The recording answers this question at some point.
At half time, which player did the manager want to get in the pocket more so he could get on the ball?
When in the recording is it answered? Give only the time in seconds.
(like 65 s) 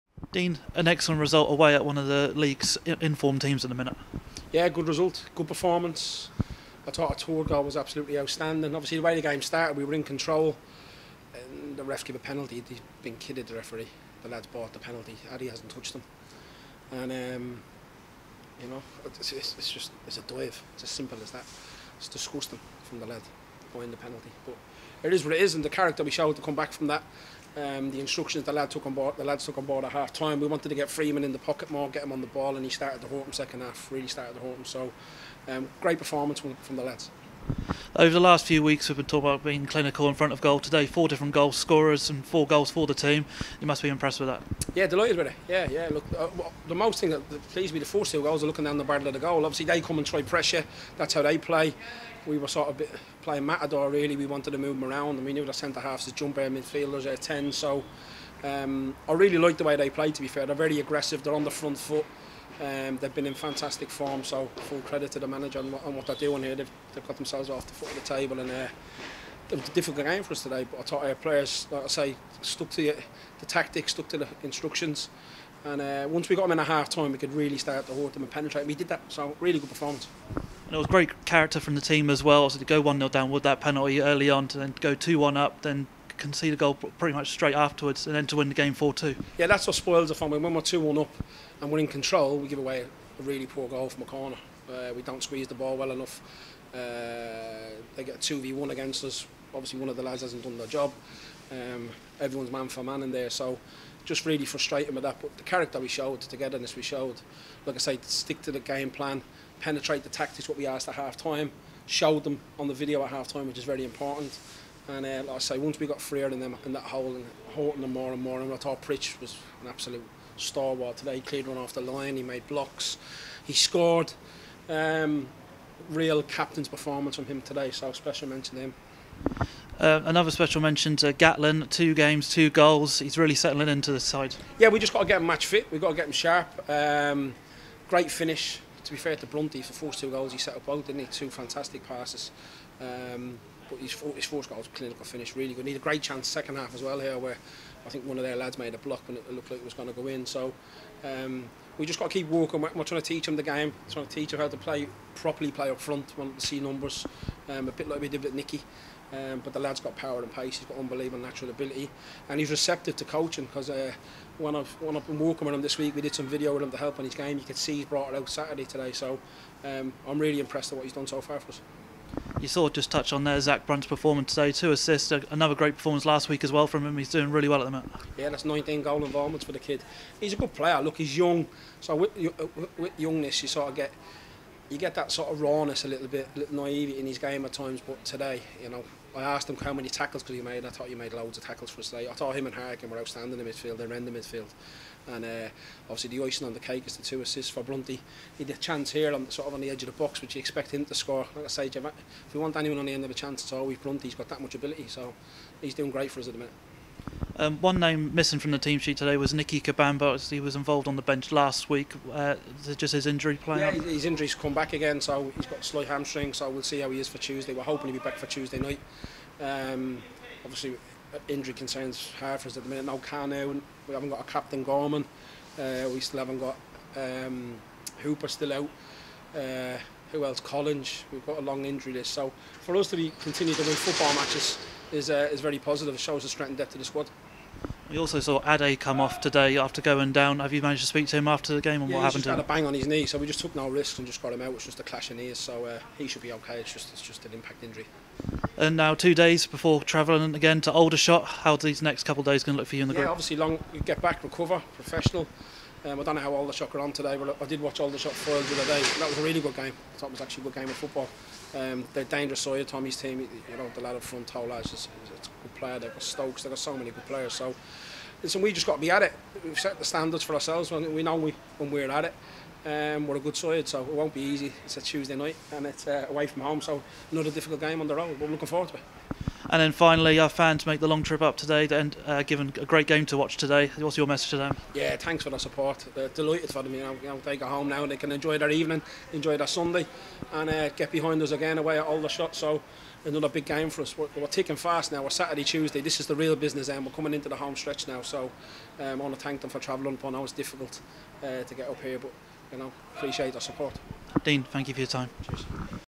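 30 s.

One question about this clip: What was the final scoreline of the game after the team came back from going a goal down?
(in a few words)
4-2.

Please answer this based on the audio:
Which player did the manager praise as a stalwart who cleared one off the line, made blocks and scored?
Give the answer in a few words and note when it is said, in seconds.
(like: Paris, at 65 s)
Pritch, at 118 s.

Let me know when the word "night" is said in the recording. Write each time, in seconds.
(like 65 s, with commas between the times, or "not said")
218 s, 275 s.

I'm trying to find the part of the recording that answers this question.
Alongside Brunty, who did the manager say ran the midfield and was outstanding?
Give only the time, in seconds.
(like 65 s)
192 s.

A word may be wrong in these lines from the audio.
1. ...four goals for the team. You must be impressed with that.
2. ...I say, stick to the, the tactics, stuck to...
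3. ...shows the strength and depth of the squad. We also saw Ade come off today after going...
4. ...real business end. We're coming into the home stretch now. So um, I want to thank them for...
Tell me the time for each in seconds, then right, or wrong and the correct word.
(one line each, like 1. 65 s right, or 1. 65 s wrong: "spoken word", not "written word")
1. 42 s right
2. 71 s wrong: "stuck", not "stick"
3. 236 s right
4. 296 s right.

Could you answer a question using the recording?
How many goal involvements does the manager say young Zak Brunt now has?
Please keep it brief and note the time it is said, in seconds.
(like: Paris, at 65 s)
19, at 178 s.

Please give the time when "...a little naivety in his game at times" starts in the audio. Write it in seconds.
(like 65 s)
186 s.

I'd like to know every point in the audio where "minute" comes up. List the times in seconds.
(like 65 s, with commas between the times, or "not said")
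3 s, 206 s, 222 s.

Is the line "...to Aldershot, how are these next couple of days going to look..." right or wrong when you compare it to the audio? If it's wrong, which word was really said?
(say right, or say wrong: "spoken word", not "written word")
right.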